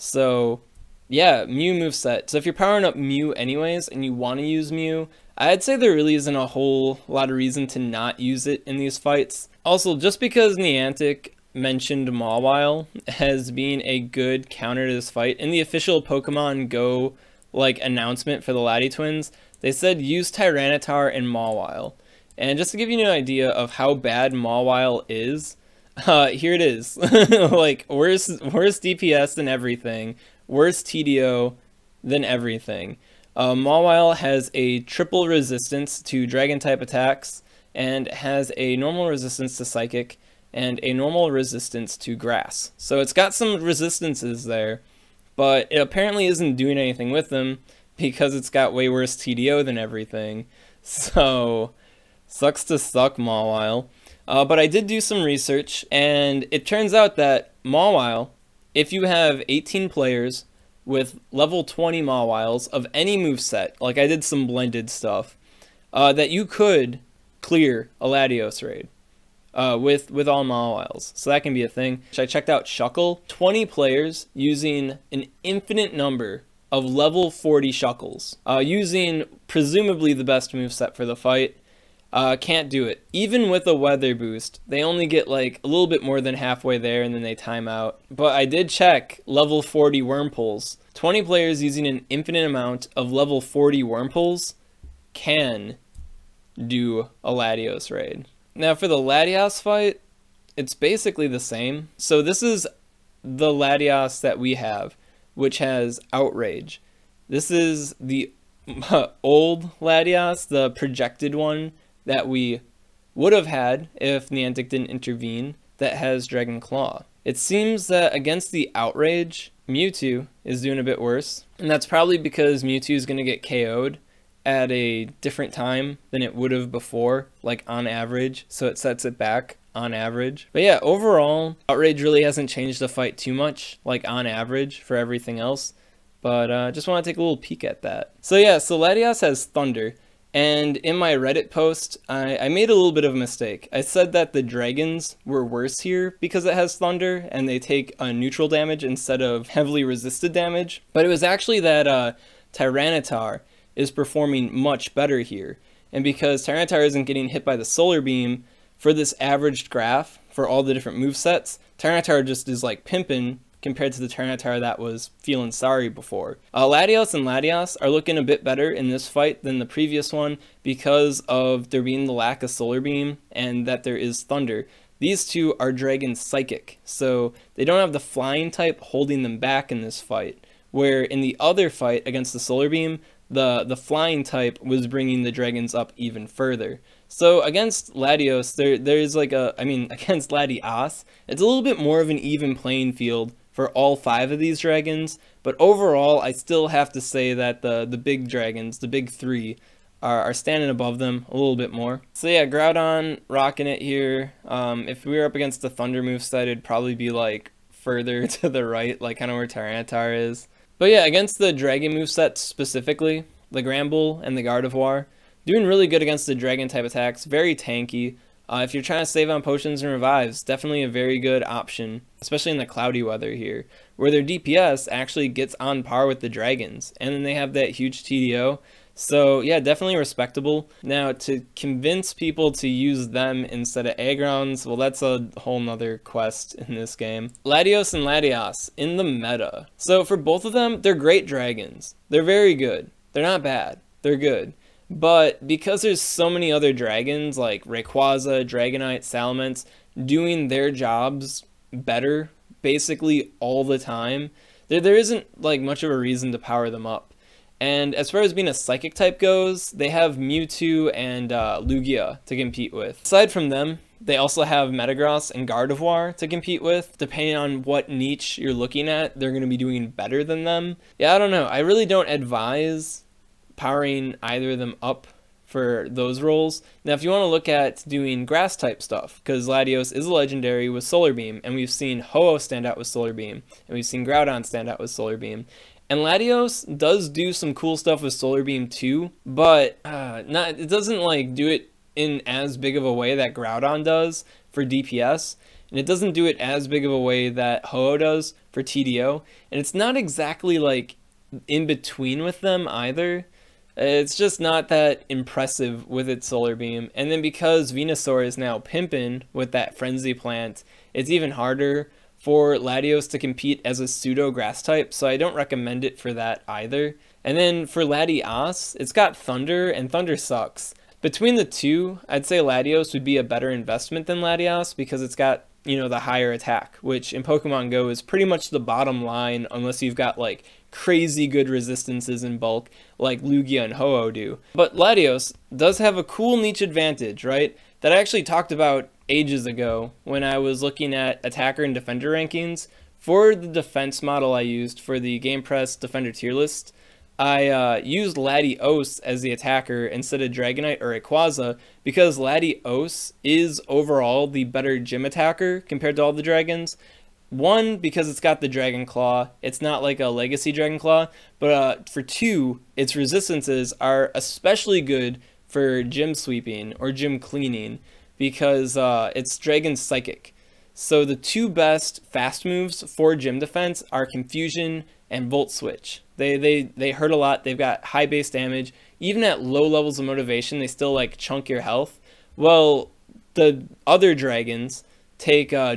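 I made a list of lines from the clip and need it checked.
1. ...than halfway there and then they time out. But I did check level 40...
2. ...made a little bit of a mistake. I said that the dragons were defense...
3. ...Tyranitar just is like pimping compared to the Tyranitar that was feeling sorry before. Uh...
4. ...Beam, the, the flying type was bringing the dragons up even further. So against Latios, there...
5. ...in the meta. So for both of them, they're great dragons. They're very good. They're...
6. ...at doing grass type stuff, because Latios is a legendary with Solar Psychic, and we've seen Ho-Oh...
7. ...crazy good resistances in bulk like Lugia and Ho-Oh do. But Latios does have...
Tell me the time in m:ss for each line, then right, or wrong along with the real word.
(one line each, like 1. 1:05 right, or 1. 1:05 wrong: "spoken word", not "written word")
1. 1:26 right
2. 2:22 wrong: "worse", not "defense"
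3. 2:41 right
4. 3:02 right
5. 3:58 right
6. 4:37 wrong: "Beam", not "Psychic"
7. 5:30 right.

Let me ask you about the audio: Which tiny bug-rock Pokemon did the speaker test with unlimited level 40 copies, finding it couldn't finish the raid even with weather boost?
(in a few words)
Shuckle.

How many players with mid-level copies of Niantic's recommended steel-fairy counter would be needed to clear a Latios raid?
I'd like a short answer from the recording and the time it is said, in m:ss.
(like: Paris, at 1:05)
18, at 0:59.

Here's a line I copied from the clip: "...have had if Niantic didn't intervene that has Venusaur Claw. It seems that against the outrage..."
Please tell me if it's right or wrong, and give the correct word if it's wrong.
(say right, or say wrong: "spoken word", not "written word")
wrong: "Dragon", not "Venusaur".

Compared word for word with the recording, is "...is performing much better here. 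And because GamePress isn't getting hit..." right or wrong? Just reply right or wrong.
wrong.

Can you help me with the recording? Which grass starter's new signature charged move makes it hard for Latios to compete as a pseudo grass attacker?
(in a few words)
Frenzy Plant.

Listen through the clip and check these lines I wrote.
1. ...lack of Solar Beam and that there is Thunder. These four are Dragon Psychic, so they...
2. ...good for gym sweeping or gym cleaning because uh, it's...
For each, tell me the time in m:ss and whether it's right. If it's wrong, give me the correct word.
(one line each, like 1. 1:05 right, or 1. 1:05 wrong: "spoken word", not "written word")
1. 2:52 wrong: "two", not "four"
2. 6:04 right.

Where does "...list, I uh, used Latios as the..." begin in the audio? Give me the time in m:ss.
5:46.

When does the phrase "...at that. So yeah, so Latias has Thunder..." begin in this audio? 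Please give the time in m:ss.
2:17.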